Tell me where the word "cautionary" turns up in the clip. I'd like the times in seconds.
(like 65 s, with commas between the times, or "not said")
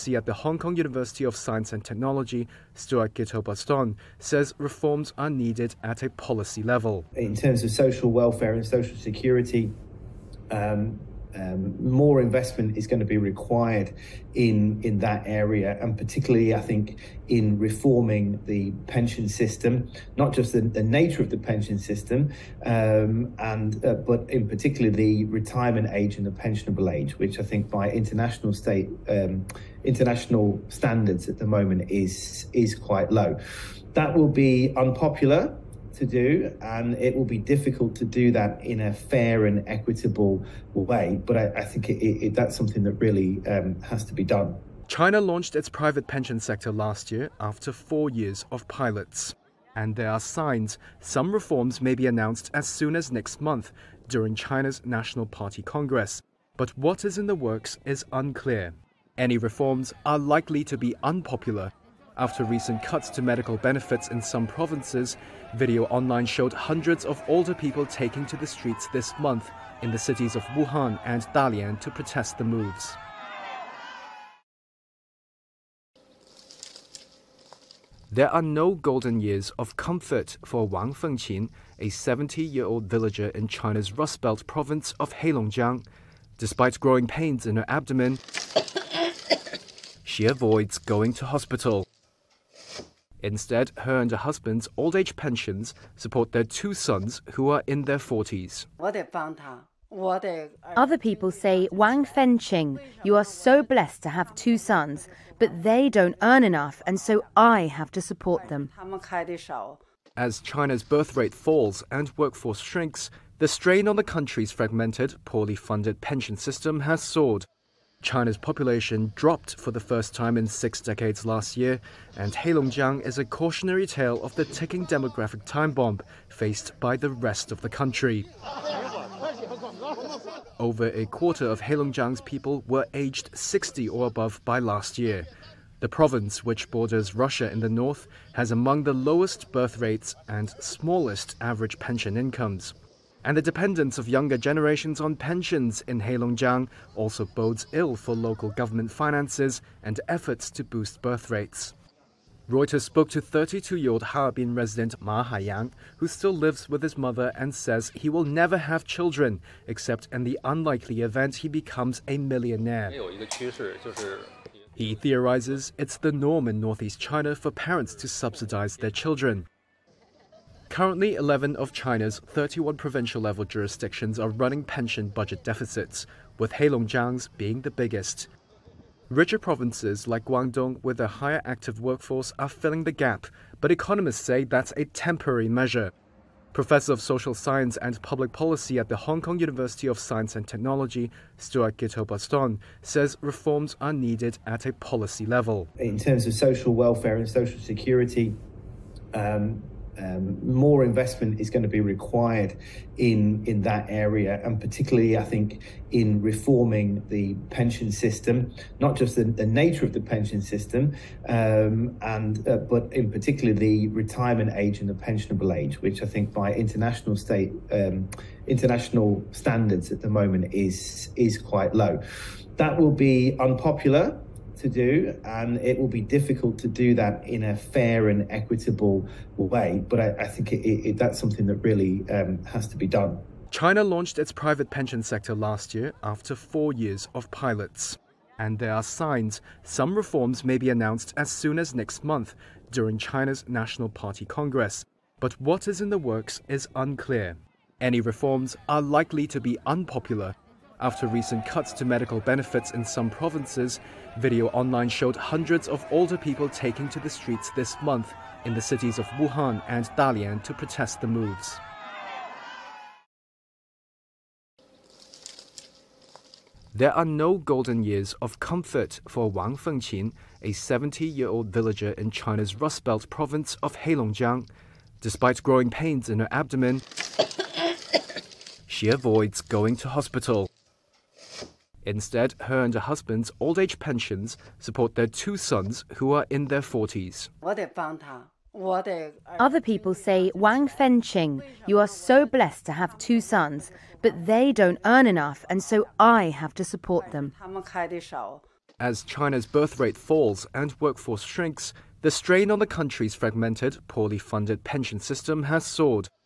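123 s.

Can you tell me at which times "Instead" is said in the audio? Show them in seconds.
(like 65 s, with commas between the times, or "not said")
93 s, 281 s.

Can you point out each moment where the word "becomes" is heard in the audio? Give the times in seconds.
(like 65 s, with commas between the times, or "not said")
161 s.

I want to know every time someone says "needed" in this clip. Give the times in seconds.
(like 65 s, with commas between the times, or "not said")
5 s, 193 s.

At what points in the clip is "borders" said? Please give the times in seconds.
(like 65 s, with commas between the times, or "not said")
136 s.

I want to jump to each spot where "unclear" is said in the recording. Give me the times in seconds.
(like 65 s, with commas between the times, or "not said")
58 s, 246 s.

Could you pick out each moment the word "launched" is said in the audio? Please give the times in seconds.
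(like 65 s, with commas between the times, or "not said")
45 s, 233 s.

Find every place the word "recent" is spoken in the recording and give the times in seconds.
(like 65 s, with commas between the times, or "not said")
62 s, 251 s.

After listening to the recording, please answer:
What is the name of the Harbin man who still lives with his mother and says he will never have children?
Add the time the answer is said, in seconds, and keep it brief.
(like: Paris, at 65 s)
Ma Haiyang, at 154 s.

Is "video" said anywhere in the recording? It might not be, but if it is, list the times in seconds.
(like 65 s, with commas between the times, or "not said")
65 s, 254 s.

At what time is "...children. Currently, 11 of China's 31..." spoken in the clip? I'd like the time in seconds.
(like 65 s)
168 s.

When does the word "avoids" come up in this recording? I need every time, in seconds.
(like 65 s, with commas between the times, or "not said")
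90 s, 278 s.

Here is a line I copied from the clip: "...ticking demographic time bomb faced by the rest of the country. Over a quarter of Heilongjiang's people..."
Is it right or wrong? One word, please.
right.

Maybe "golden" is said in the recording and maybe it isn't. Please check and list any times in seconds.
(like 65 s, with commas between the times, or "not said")
78 s, 267 s.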